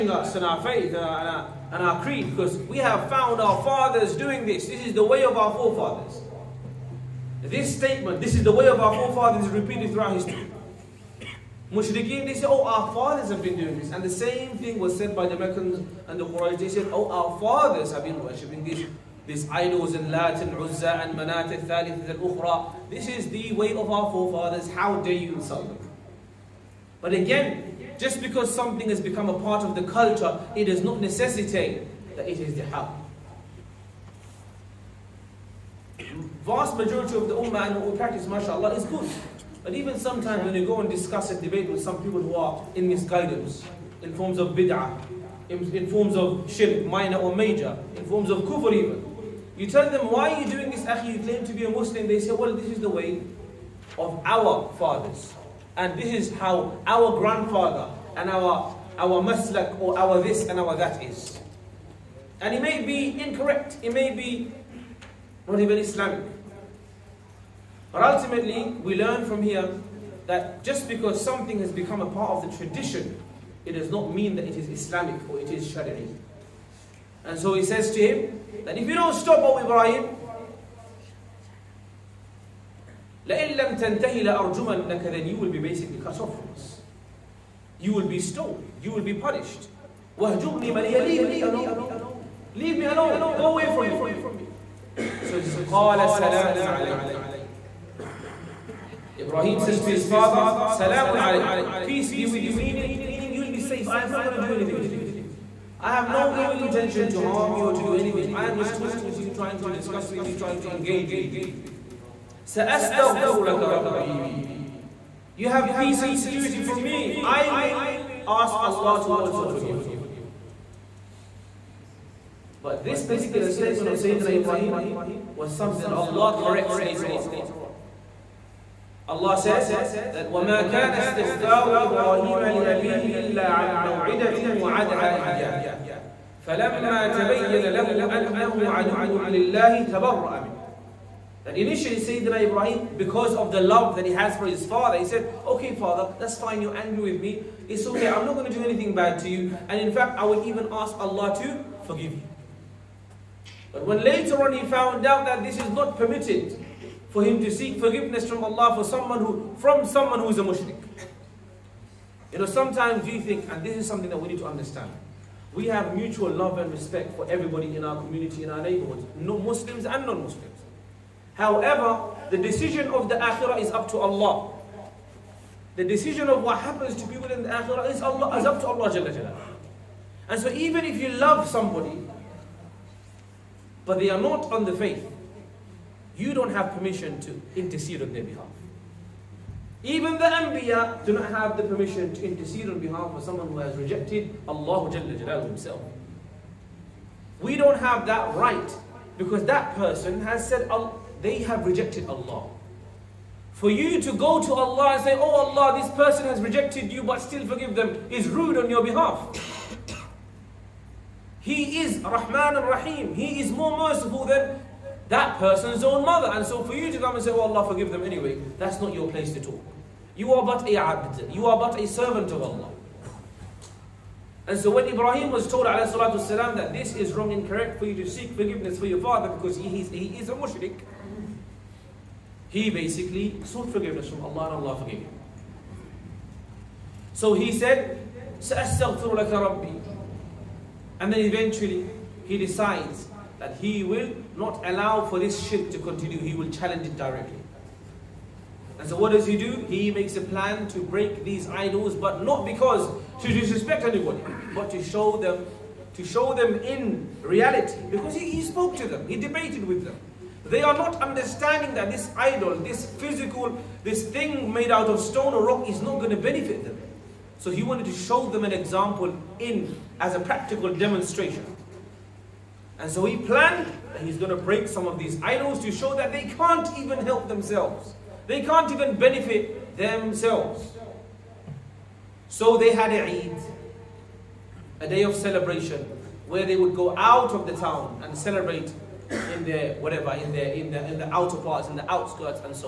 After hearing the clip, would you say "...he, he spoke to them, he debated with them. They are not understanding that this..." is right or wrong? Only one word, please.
right.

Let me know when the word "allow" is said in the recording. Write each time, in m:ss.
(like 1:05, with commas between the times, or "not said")
4:04.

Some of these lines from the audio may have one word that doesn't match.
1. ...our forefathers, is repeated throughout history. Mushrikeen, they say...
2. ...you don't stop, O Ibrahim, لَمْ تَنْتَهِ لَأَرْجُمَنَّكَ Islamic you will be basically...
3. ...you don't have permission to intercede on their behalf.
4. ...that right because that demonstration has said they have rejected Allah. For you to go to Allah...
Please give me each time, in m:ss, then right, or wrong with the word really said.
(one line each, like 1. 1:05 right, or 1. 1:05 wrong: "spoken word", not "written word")
1. 0:08 right
2. 1:18 wrong: "Then", not "Islamic"
3. 3:06 right
4. 3:18 wrong: "person", not "demonstration".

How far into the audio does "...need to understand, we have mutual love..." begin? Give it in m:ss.
2:44.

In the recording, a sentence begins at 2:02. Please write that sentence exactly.
But this particular statement of Sayyidina Ibrahim was something that Allah corrects later on.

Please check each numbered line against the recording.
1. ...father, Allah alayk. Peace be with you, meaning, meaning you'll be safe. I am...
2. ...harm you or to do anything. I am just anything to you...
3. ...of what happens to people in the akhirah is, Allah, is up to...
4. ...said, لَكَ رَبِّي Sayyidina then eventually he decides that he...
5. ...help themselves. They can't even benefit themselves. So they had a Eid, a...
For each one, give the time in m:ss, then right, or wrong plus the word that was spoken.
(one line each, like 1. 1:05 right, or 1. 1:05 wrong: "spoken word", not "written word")
1. 1:40 wrong: "Salamun", not "Allah"
2. 1:47 wrong: "talking", not "anything"
3. 2:56 right
4. 3:57 wrong: "And", not "Sayyidina"
5. 4:37 right.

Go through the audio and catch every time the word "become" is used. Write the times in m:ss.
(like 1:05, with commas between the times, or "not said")
0:28, 1:11.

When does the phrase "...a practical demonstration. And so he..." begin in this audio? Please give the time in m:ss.
4:30.